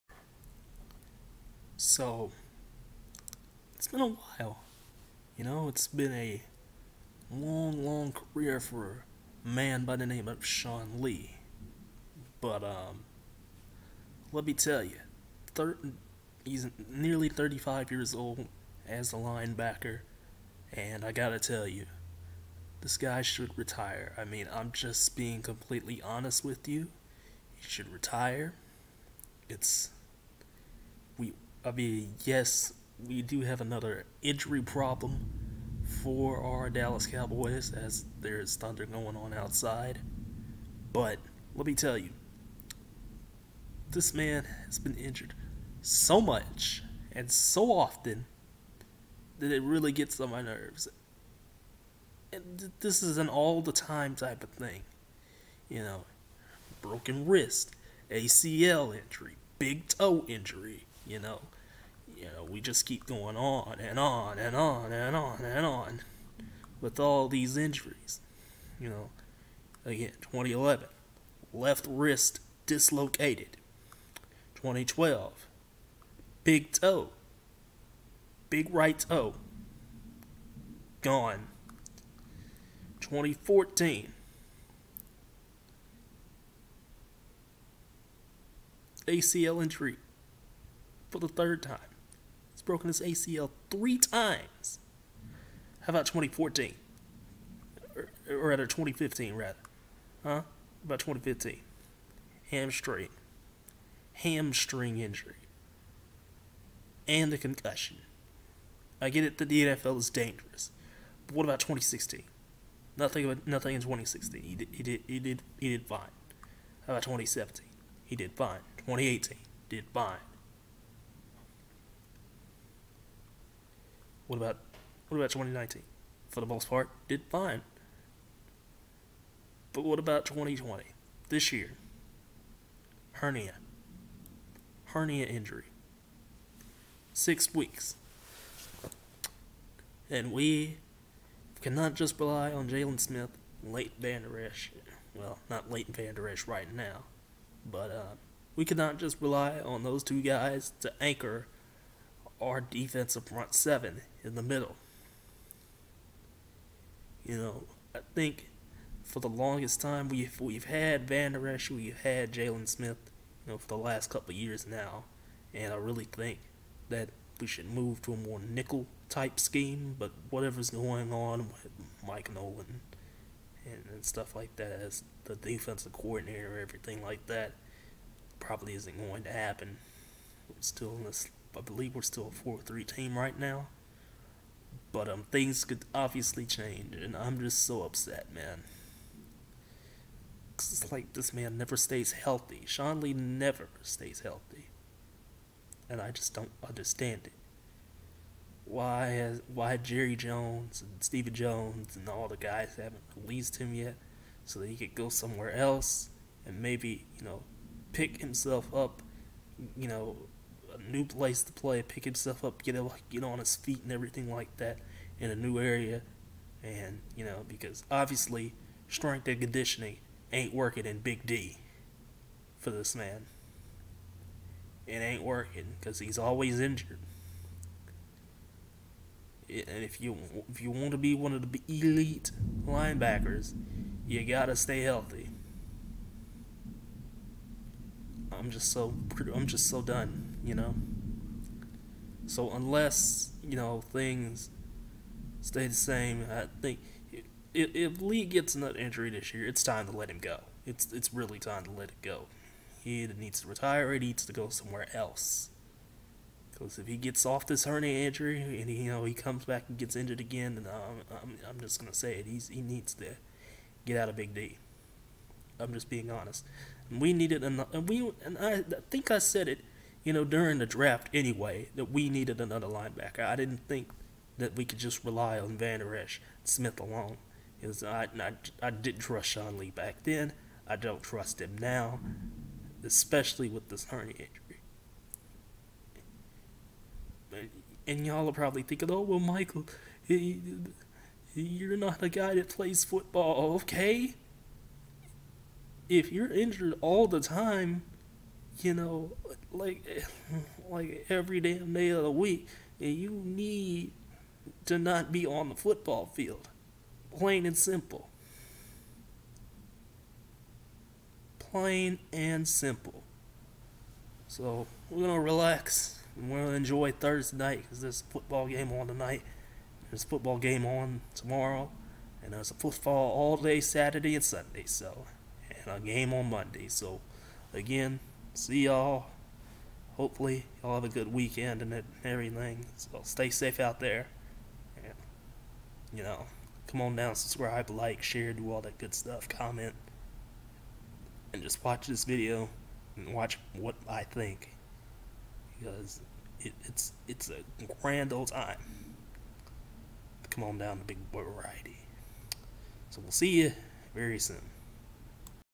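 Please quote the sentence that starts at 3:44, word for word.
It ain't working because he's always injured.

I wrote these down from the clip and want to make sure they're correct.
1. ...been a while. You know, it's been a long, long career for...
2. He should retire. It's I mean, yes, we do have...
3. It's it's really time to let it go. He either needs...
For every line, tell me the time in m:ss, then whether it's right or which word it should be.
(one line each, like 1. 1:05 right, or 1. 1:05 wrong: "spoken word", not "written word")
1. 0:03 right
2. 0:27 right
3. 4:10 right.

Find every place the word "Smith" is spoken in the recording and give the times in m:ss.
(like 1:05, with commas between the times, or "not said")
2:23, 2:42, 4:36.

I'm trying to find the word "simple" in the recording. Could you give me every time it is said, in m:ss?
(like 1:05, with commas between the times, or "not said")
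5:07, 5:12.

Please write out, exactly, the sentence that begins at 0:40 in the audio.
But let me tell you, this man has been injured so much and so often that it really gets on my nerves.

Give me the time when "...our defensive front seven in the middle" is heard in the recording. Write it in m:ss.
2:32.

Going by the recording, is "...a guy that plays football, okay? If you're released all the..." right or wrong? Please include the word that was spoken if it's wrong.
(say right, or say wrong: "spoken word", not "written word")
wrong: "injured", not "released".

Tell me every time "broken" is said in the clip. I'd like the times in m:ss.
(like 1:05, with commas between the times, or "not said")
0:56, 1:32.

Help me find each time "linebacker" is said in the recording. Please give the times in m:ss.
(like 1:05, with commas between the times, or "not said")
0:19, 3:52, 4:32.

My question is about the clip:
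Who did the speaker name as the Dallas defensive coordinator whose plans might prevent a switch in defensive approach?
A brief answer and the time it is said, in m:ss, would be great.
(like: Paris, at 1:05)
Mike Nolan, at 2:52.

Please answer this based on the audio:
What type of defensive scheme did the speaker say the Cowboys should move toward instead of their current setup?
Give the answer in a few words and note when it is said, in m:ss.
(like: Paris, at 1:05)
nickel, at 2:48.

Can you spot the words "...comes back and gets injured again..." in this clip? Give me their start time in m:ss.
4:19.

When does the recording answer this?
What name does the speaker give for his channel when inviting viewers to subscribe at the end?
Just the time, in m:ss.
5:50.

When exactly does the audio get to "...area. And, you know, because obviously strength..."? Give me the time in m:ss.
3:35.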